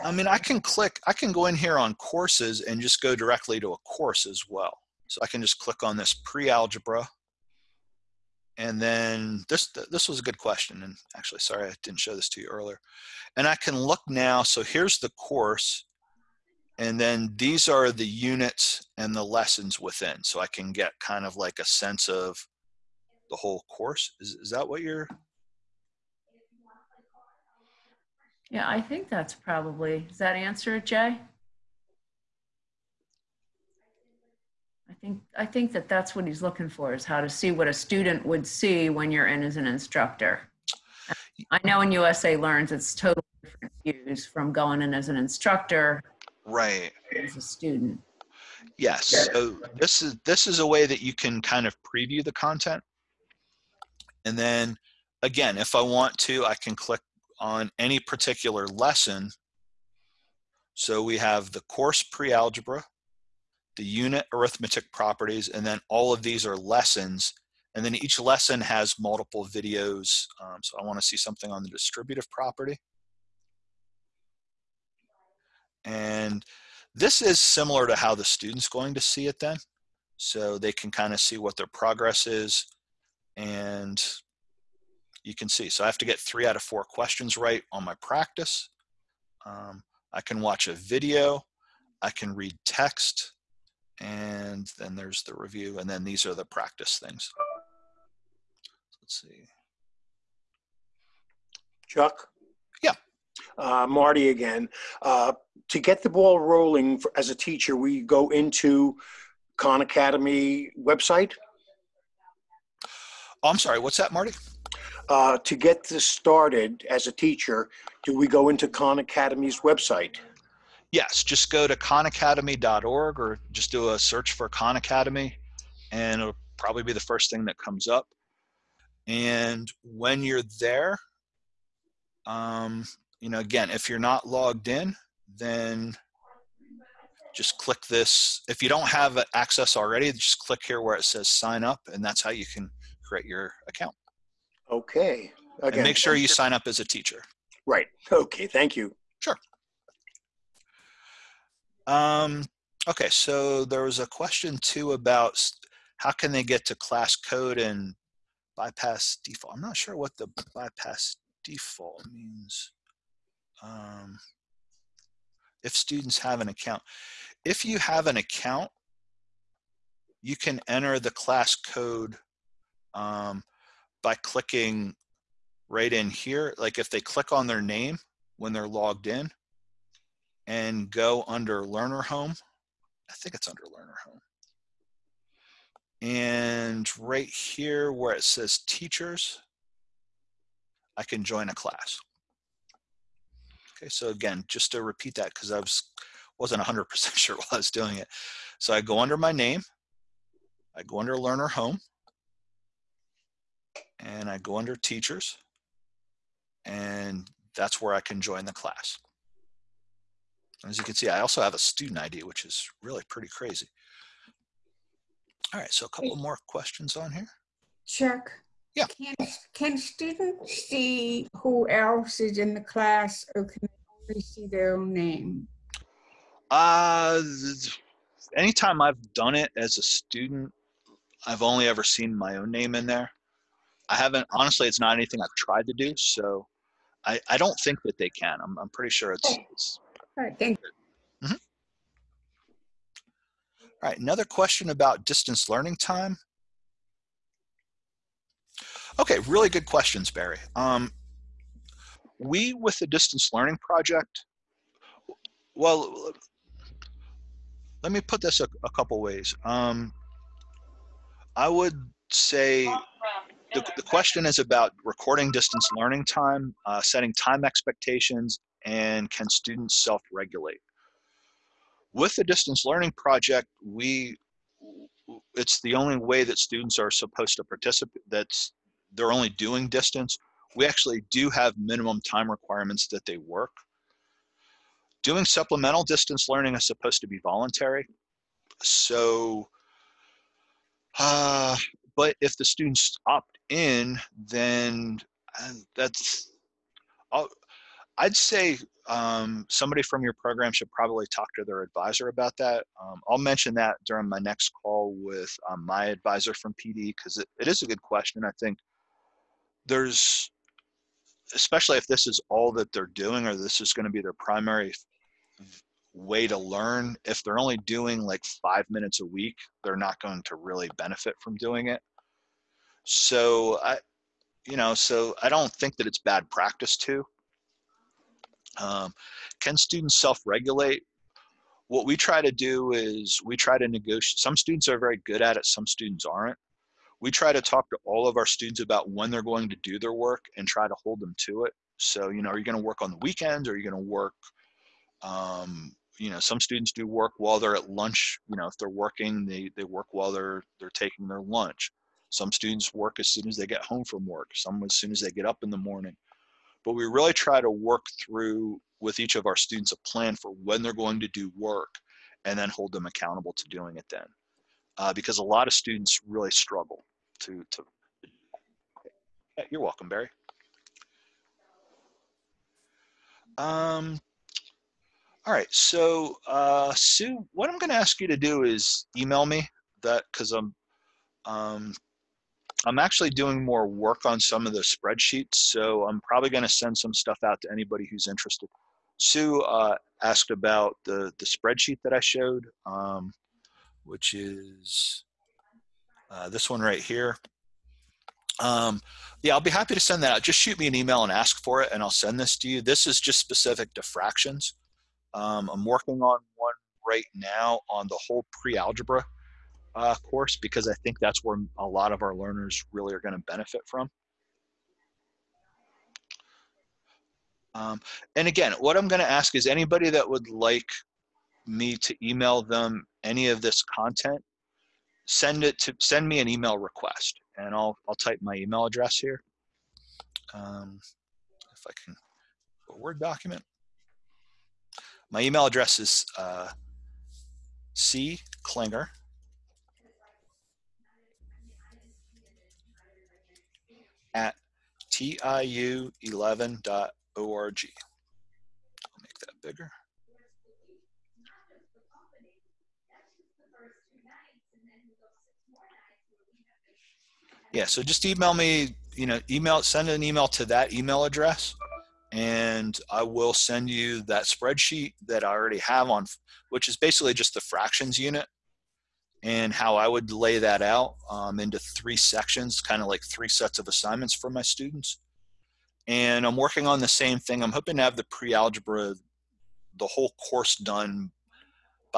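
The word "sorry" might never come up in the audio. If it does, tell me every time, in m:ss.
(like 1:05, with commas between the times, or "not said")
0:11, 1:53.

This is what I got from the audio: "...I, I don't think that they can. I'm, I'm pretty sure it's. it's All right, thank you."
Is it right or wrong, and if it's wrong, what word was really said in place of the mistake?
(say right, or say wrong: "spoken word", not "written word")
right.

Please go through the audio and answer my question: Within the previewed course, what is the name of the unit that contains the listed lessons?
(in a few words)
Arithmetic properties.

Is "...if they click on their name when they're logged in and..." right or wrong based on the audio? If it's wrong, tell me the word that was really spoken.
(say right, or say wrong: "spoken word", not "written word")
right.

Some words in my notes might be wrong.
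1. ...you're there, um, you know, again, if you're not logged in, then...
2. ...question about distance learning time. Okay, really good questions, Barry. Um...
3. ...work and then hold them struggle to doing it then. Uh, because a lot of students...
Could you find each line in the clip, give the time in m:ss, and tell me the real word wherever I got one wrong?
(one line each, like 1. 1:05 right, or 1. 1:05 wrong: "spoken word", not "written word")
1. 2:10 right
2. 4:04 right
3. 6:01 wrong: "accountable", not "struggle".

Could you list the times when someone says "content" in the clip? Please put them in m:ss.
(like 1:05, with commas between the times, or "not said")
0:52, 7:03.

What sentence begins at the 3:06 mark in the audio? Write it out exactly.
And right here where it says teachers, I can join a class.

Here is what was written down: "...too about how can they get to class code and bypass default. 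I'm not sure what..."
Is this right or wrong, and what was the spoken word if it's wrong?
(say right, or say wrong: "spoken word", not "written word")
right.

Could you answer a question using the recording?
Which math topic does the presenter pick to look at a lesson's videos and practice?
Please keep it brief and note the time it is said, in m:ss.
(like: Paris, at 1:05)
Distributive property, at 1:11.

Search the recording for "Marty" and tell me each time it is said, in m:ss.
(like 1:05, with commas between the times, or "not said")
1:43, 1:54.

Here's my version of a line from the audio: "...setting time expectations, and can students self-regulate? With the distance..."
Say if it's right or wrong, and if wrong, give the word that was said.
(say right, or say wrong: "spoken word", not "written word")
right.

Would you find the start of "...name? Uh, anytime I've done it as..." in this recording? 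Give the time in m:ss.
3:44.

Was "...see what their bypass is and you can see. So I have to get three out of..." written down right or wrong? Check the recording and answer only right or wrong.
wrong.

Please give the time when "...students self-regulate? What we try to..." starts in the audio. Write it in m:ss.
5:29.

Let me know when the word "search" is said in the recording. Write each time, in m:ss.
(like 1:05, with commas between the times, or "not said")
2:03.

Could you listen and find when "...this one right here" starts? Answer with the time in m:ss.
6:36.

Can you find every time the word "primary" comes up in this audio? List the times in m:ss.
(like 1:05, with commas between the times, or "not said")
5:14.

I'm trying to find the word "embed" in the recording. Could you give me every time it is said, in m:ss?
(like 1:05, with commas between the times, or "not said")
not said.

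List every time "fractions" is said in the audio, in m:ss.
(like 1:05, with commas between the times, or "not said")
6:43, 7:47.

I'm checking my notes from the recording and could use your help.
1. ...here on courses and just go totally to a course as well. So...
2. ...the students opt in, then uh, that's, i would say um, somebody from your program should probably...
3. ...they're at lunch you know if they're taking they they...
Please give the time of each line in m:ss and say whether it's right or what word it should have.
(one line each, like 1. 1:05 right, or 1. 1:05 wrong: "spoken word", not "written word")
1. 0:01 wrong: "directly", not "totally"
2. 4:52 right
3. 5:47 wrong: "working", not "taking".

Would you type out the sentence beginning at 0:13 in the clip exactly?
And I can look now, so here's the course.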